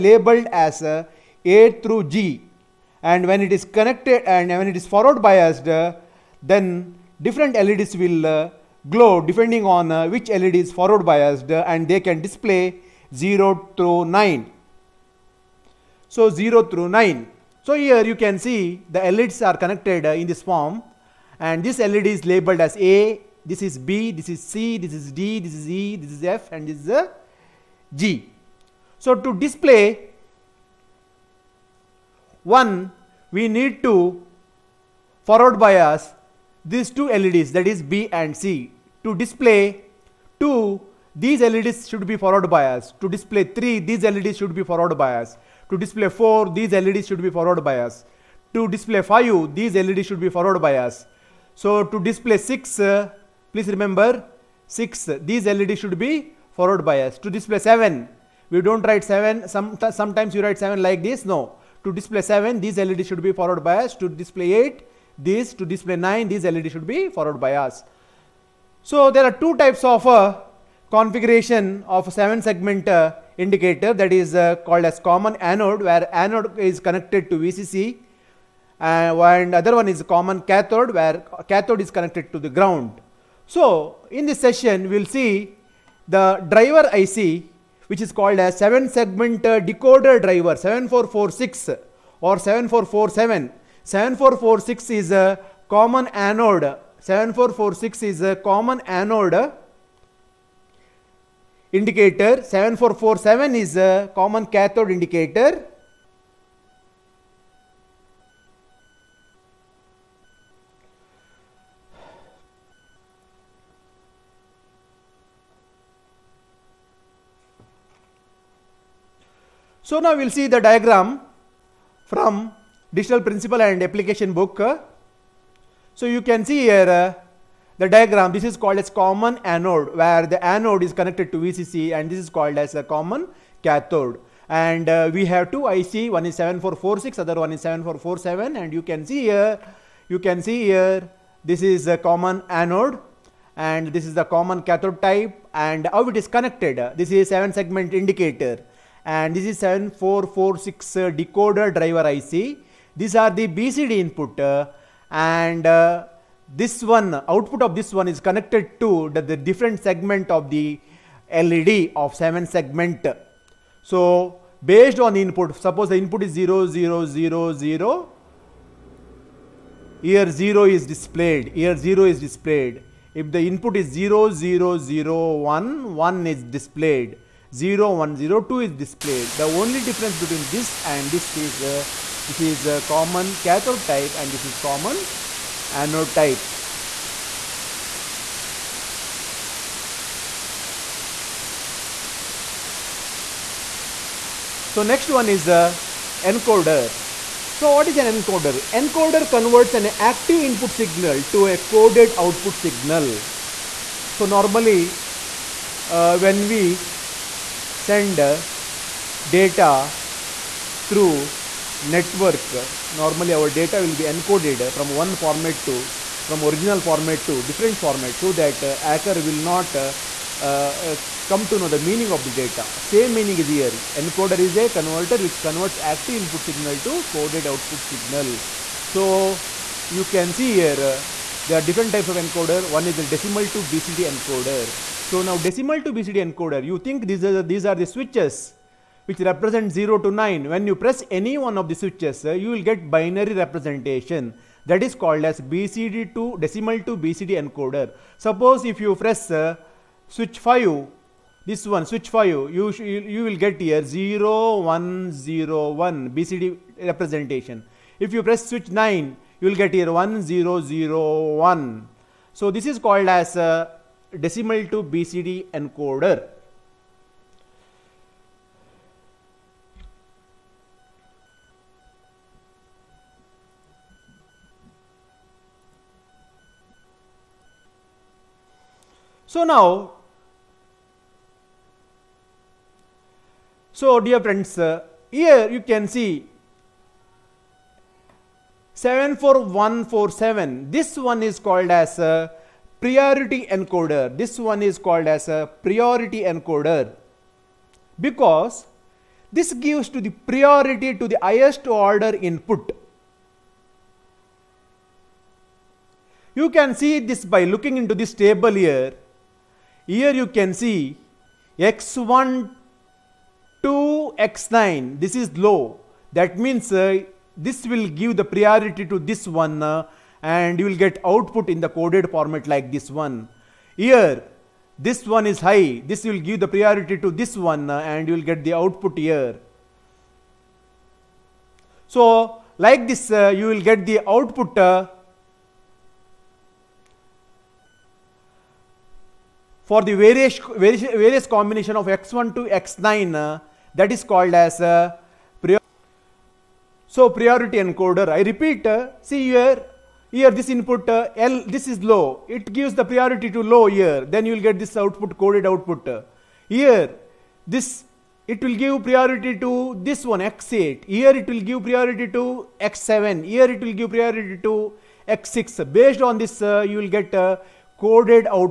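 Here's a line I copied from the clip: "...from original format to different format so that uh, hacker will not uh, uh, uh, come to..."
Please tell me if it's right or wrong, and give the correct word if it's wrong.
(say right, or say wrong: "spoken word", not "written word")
right.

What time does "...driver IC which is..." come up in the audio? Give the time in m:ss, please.
1:26.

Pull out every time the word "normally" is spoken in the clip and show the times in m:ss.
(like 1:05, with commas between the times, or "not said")
3:24, 3:32.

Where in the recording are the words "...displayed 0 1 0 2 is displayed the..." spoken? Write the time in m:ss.
2:56.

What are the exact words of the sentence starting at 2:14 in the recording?
And uh, we have two IC, one is 7446, other one is 7447.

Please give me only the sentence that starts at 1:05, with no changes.
To display 9, these LEDs should be forward bias.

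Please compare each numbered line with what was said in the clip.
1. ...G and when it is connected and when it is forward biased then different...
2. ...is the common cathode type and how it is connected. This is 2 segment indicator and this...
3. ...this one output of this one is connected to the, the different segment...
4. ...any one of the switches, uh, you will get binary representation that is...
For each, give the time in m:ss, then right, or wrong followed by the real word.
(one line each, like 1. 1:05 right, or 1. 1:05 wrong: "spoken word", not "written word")
1. 0:02 right
2. 2:24 wrong: "7", not "2"
3. 2:36 right
4. 4:01 right.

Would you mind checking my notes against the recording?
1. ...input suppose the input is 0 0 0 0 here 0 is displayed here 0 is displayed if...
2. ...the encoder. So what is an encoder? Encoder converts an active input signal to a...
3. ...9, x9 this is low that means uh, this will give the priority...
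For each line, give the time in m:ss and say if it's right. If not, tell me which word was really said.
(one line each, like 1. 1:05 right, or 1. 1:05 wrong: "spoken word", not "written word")
1. 2:45 right
2. 3:15 right
3. 5:13 wrong: "2", not "9".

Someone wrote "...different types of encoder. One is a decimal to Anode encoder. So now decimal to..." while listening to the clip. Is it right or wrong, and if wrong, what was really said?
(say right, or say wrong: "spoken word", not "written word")
wrong: "BCD", not "Anode".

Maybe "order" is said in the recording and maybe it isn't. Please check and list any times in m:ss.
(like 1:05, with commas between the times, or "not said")
5:01.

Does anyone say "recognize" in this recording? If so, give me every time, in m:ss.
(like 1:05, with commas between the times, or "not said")
not said.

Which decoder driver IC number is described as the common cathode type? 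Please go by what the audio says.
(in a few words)
7447.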